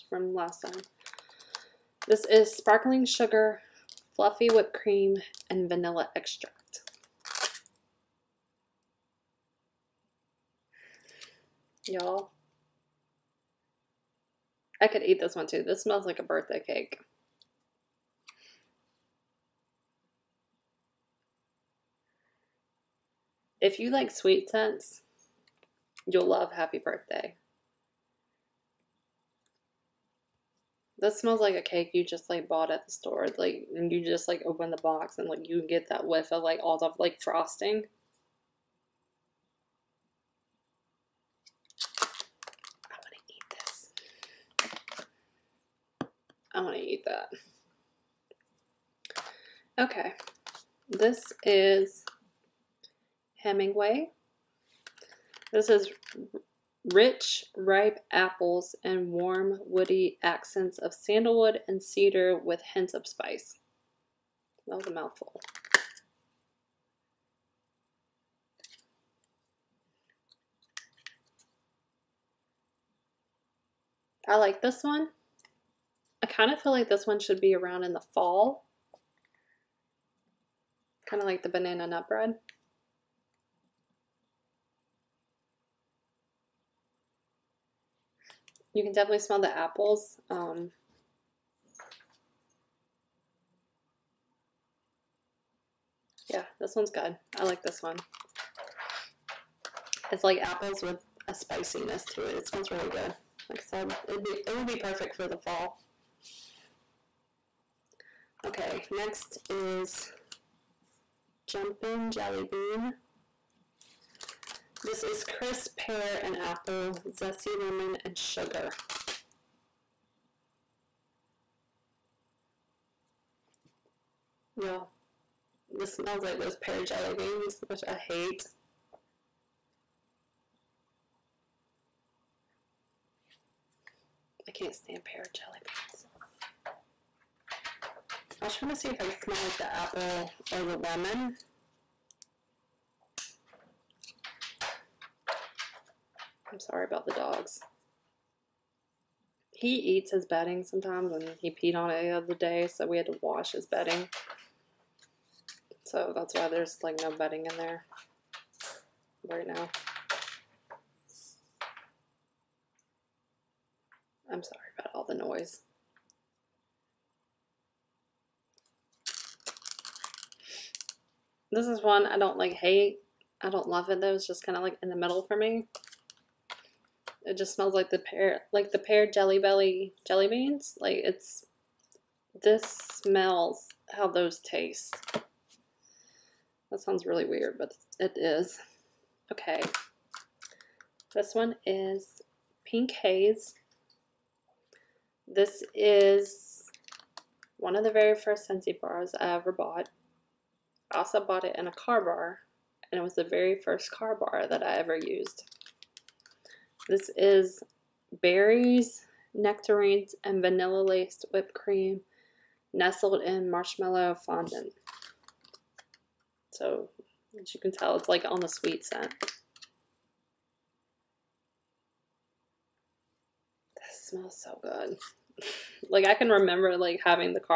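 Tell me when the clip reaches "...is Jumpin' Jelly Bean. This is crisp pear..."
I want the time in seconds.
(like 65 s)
109 s.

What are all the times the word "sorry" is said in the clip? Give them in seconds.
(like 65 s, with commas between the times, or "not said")
146 s, 164 s.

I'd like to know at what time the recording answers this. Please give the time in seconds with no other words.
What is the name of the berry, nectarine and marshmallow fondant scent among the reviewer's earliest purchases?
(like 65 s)
192 s.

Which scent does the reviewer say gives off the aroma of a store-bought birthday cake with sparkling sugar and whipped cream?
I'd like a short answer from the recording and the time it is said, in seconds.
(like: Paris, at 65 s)
Happy Birthday, at 26 s.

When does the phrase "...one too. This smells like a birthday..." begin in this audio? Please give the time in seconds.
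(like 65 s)
15 s.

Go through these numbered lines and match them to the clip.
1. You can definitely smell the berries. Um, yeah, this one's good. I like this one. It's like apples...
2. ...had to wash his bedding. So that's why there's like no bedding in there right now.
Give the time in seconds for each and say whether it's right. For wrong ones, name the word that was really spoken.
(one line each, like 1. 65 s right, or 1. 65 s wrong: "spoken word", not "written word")
1. 88 s wrong: "apples", not "berries"
2. 152 s right.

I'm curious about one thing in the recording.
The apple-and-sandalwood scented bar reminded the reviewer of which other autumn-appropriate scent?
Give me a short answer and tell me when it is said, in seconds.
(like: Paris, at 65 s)
banana nut bread, at 81 s.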